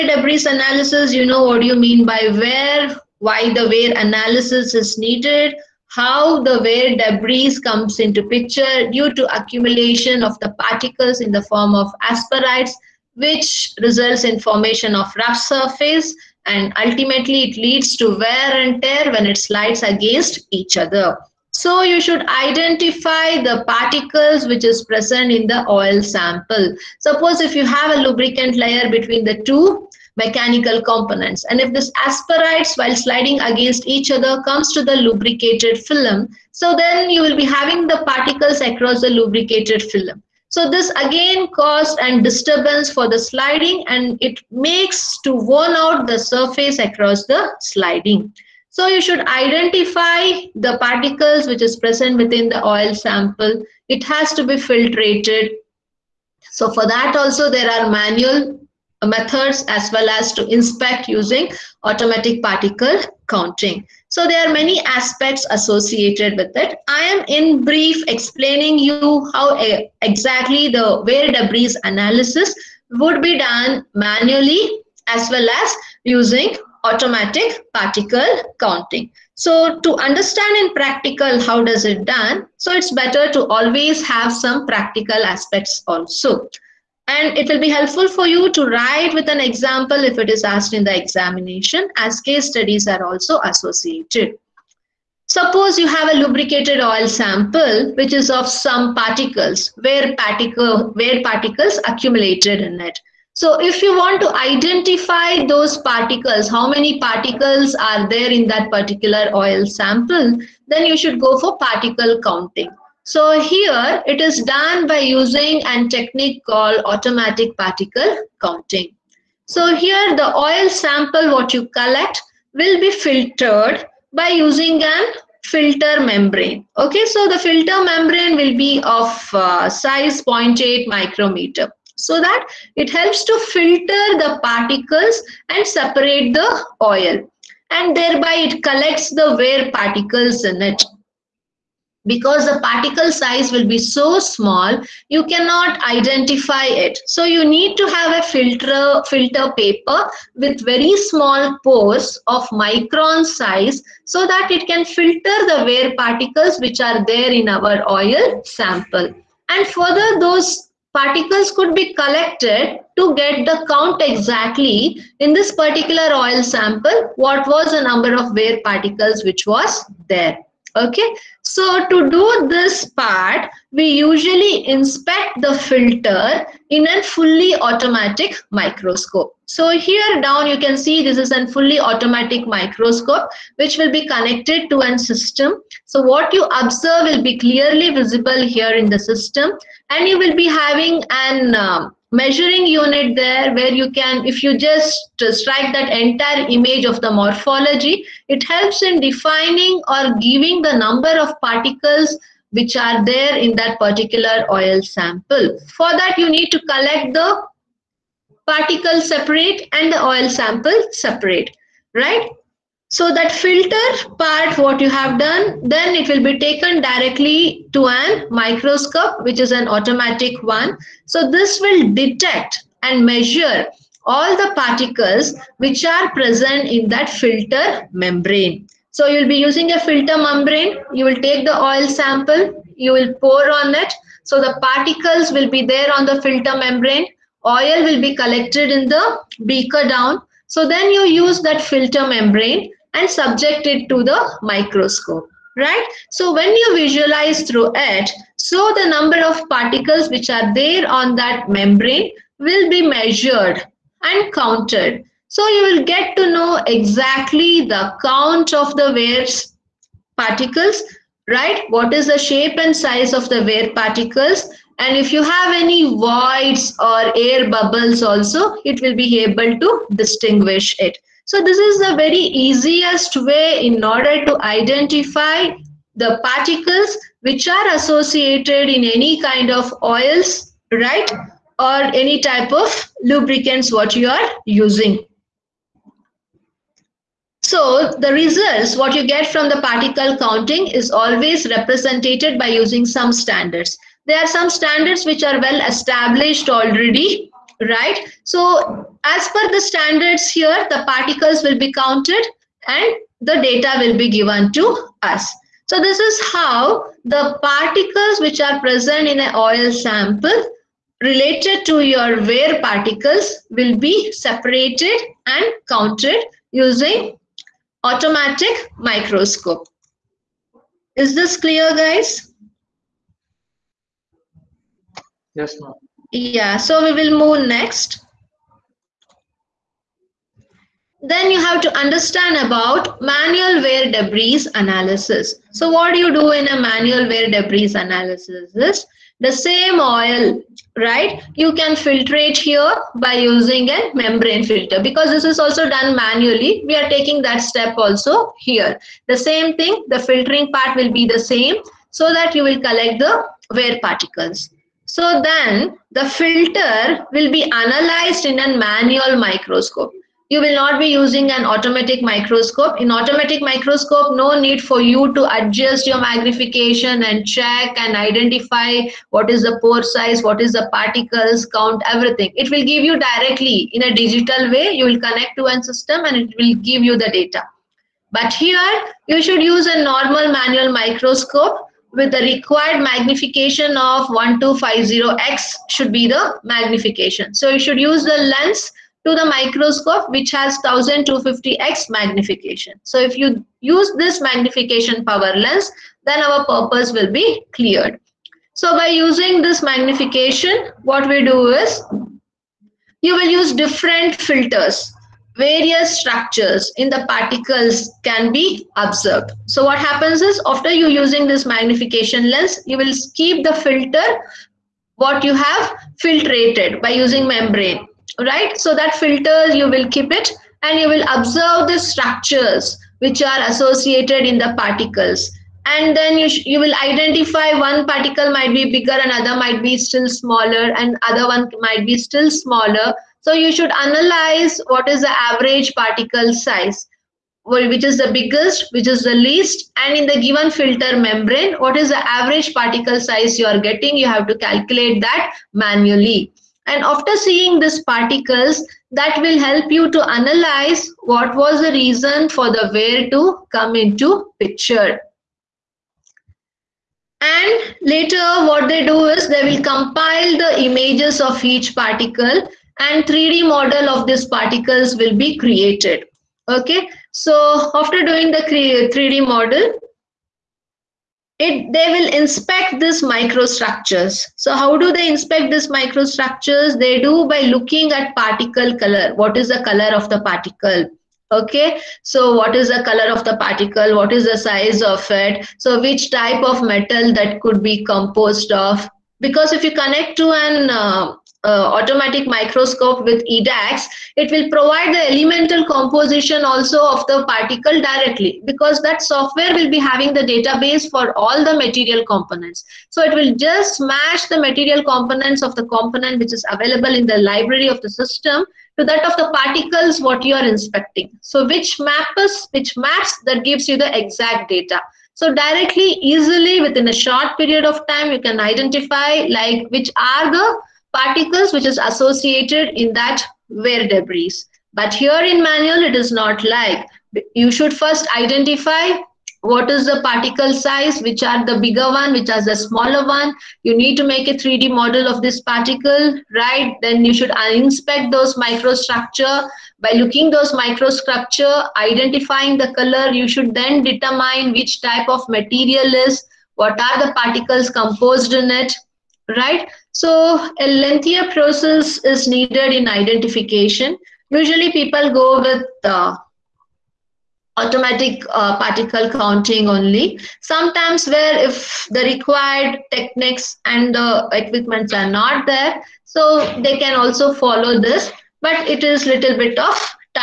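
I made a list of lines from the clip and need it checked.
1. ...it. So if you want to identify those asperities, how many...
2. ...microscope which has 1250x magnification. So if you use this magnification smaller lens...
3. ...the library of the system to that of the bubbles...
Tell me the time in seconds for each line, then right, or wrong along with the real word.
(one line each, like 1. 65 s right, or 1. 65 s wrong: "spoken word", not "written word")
1. 102 s wrong: "particles", not "asperities"
2. 389 s wrong: "power", not "smaller"
3. 507 s wrong: "particles", not "bubbles".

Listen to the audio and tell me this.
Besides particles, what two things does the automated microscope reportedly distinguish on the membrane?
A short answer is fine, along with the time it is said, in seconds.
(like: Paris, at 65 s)
voids or air bubbles, at 266 s.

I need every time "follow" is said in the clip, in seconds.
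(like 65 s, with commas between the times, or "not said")
567 s.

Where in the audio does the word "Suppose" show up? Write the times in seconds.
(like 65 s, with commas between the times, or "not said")
26 s, 95 s.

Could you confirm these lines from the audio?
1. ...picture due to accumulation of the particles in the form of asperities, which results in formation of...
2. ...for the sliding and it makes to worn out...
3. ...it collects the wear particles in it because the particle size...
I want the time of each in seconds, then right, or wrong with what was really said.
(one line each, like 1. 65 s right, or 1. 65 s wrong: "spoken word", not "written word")
1. 8 s right
2. 42 s right
3. 138 s right.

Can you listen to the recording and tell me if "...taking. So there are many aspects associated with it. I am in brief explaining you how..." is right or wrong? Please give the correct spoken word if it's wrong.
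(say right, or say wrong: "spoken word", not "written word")
wrong: "counting", not "taking".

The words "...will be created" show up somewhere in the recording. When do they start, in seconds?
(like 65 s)
464 s.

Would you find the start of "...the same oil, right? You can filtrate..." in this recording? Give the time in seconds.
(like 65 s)
339 s.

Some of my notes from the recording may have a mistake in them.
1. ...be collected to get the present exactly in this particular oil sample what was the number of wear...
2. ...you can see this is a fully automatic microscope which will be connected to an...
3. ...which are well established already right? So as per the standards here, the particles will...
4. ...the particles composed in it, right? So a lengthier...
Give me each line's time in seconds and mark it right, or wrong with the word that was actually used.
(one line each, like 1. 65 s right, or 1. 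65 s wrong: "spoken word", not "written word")
1. 161 s wrong: "count", not "present"
2. 180 s right
3. 295 s right
4. 547 s right.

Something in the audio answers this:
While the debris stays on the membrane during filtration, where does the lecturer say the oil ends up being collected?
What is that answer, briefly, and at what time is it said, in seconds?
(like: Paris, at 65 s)
in the beaker, at 238 s.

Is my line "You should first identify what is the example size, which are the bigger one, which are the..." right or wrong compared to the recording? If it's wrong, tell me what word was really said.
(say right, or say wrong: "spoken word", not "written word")
wrong: "particle", not "example".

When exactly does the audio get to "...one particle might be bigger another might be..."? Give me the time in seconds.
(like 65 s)
427 s.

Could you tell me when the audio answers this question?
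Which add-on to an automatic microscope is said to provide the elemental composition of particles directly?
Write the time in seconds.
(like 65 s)
493 s.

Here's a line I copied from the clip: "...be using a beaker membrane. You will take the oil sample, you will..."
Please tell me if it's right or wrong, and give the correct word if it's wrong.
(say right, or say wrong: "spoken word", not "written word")
wrong: "filter", not "beaker".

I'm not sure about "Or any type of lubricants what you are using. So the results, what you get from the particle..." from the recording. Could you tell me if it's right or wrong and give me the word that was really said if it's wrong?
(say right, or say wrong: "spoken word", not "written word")
right.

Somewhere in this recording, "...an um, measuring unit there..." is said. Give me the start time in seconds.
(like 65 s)
191 s.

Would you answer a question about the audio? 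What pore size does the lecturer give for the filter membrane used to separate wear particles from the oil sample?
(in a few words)
0.8 micrometer.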